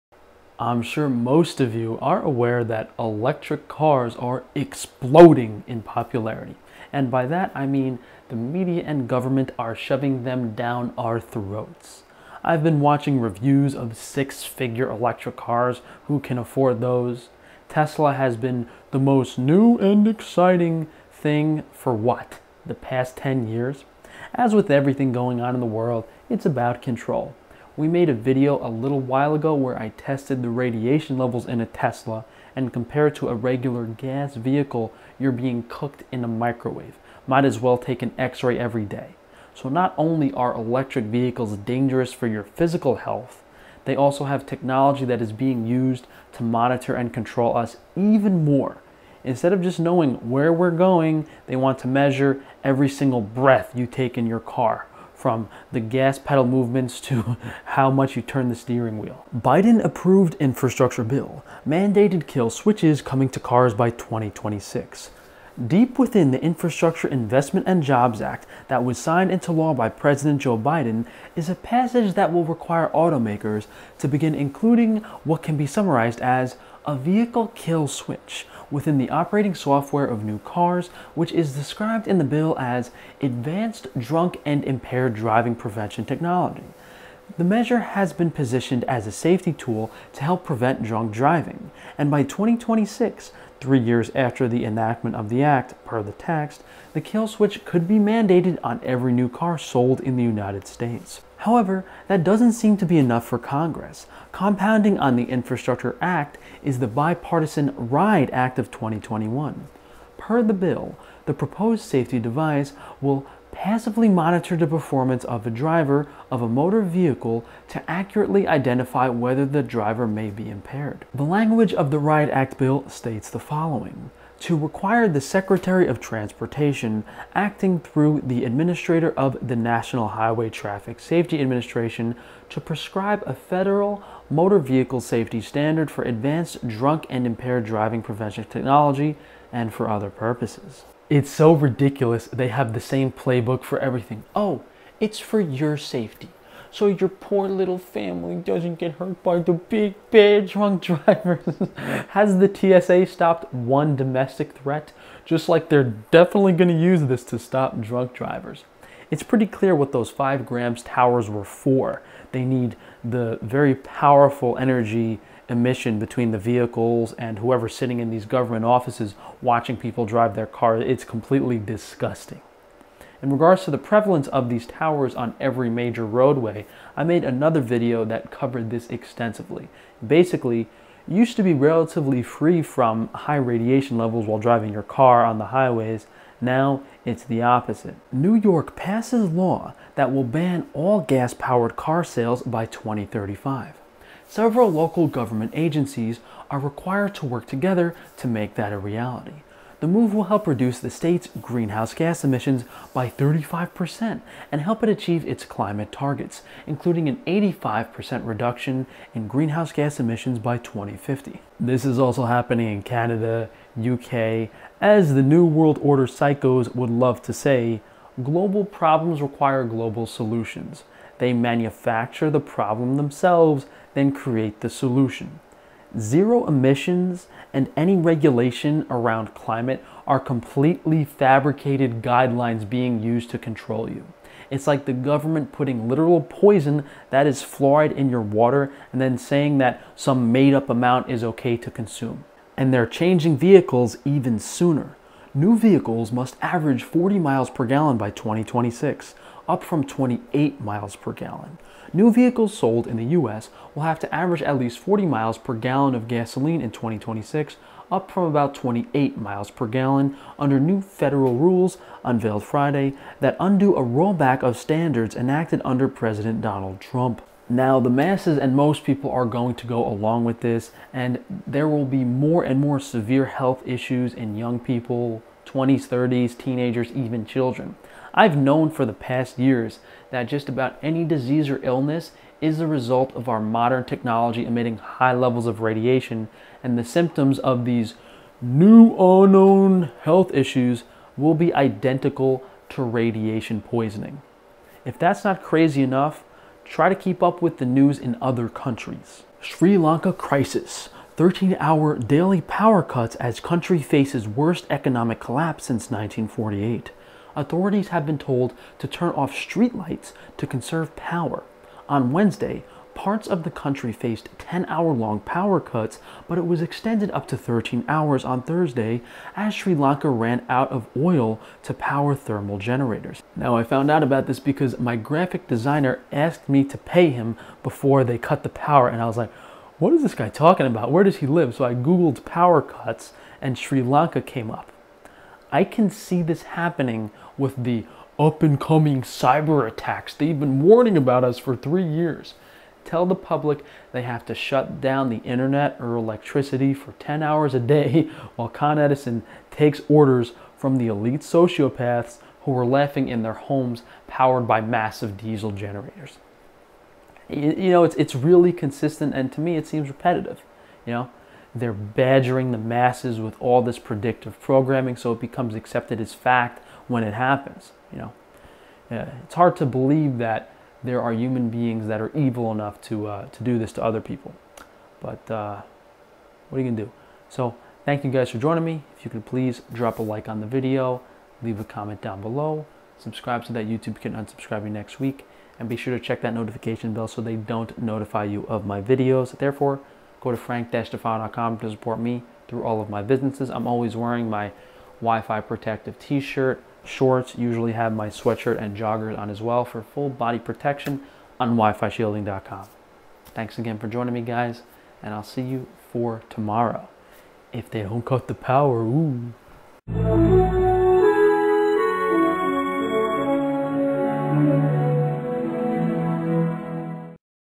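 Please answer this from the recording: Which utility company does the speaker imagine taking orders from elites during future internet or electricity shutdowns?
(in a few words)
Con Edison.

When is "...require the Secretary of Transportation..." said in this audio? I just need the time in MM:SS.
02:04.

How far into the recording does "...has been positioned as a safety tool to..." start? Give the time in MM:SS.
01:27.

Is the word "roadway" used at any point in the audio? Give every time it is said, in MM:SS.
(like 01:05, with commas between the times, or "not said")
02:56.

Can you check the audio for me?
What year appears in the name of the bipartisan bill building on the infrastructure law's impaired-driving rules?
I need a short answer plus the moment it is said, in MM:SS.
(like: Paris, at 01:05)
2021, at 01:48.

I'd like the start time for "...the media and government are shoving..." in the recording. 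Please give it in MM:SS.
00:08.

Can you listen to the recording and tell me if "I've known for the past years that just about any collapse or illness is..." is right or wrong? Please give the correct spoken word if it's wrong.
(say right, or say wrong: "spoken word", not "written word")
wrong: "disease", not "collapse".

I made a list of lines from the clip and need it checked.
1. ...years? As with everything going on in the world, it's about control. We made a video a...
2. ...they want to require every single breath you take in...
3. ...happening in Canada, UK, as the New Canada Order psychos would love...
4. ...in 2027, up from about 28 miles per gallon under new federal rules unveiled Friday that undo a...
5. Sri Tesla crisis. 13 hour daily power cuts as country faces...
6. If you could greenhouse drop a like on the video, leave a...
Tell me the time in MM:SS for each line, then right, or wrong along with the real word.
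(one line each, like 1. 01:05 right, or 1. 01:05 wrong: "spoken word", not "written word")
1. 00:23 right
2. 00:51 wrong: "measure", not "require"
3. 03:32 wrong: "World", not "Canada"
4. 04:16 wrong: "2026", not "2027"
5. 04:59 wrong: "Lanka", not "Tesla"
6. 06:18 wrong: "please", not "greenhouse".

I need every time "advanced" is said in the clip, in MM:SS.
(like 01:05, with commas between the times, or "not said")
01:23, 02:16.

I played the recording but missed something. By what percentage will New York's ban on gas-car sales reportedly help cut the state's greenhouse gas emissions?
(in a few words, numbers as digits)
35%.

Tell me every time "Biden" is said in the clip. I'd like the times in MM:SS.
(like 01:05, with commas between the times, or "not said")
00:59, 01:10.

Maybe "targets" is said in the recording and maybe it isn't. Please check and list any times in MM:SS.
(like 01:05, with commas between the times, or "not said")
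03:25.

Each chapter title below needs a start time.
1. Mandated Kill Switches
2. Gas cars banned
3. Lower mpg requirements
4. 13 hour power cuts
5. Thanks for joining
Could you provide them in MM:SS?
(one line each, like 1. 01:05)
1. 00:59
2. 03:07
3. 04:02
4. 04:59
5. 06:17.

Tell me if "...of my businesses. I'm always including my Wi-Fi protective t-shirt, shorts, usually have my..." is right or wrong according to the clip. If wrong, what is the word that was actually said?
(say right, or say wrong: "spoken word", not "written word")
wrong: "wearing", not "including".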